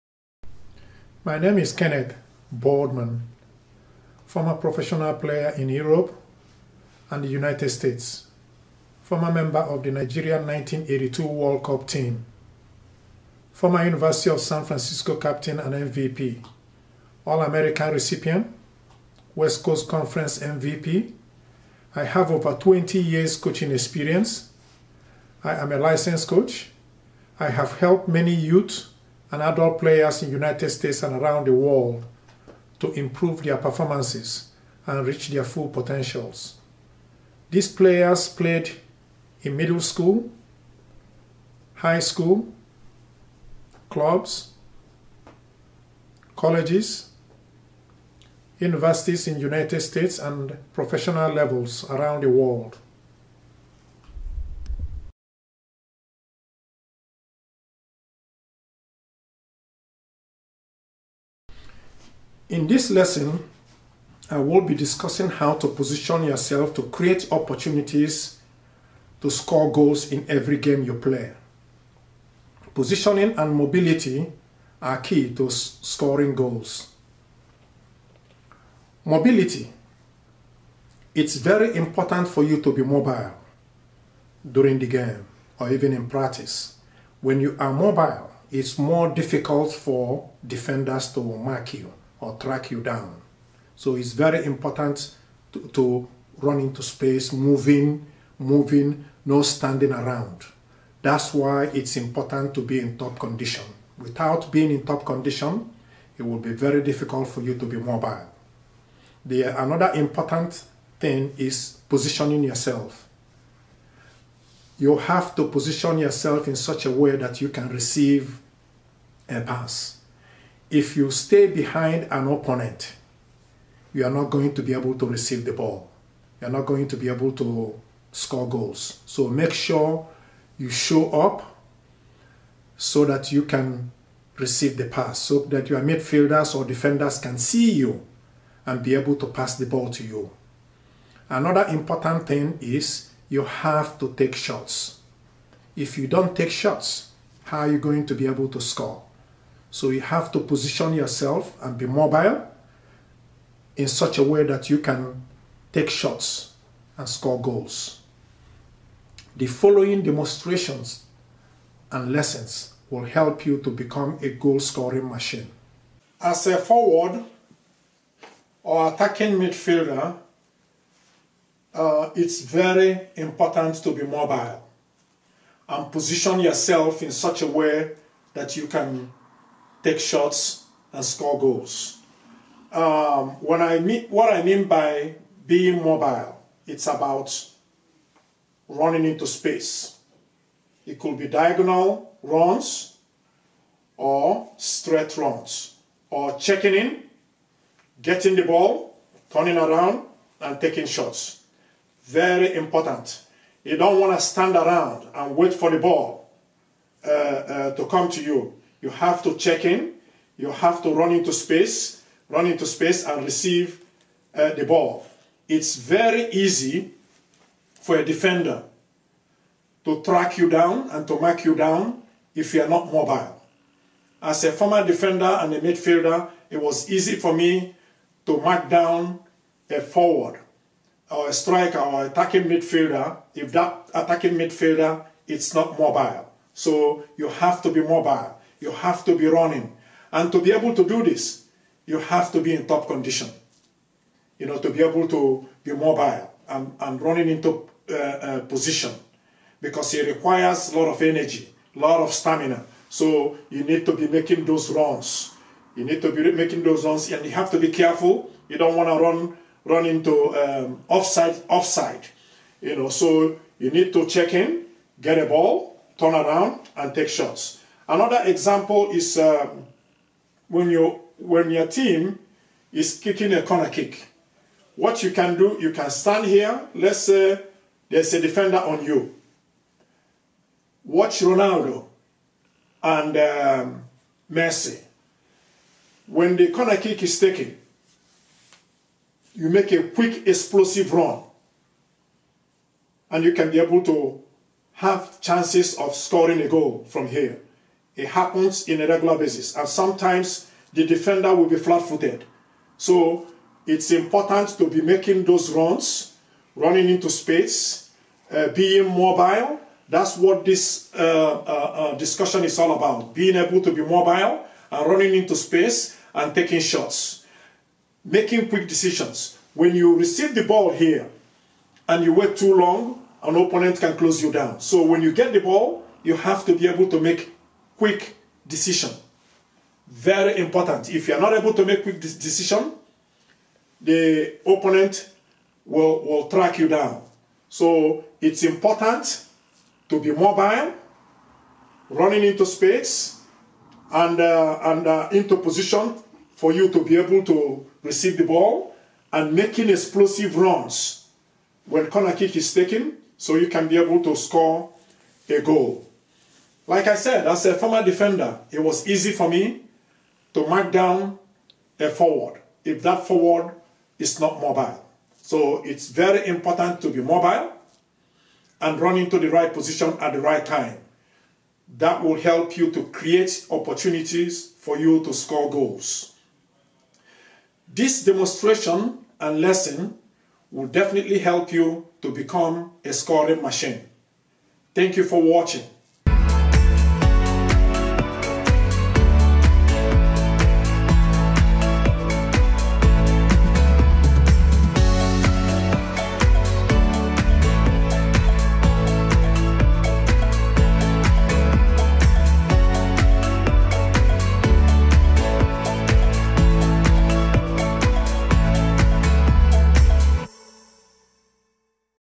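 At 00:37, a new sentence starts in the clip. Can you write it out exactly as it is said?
These players played in middle school, high school, clubs, colleges, universities in United States and professional levels around the world.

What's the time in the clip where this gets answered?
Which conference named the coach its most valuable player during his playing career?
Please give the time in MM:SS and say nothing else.
00:19.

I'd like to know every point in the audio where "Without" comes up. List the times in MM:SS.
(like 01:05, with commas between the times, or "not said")
01:43.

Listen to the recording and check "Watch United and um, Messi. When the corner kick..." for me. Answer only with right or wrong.
wrong.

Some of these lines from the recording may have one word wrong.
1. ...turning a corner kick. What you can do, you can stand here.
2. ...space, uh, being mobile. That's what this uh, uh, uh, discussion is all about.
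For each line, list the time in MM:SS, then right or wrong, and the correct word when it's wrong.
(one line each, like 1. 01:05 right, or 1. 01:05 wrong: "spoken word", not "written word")
1. 04:32 wrong: "kicking", not "turning"
2. 05:07 right.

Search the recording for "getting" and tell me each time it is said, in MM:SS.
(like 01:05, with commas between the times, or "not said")
03:18.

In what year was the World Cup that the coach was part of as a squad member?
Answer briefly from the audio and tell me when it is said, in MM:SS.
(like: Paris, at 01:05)
1982, at 00:10.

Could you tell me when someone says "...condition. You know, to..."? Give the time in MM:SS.
04:02.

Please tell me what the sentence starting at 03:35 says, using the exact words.
It's very easy for a defender to track you down and to mark you down if you are not mobile.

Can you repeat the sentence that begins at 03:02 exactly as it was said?
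Um, when I mean, what I mean by being mobile, it's about running into space.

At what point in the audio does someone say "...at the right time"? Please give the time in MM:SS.
06:09.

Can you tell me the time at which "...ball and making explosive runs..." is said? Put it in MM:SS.
05:48.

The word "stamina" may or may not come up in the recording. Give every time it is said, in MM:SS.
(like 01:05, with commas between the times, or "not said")
04:12.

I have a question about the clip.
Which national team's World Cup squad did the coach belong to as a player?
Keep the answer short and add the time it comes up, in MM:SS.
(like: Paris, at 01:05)
Nigeria, at 00:09.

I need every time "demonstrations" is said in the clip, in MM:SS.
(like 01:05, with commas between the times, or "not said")
02:40, 06:18.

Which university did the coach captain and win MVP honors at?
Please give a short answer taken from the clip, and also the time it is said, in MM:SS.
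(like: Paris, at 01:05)
University of San Francisco, at 00:13.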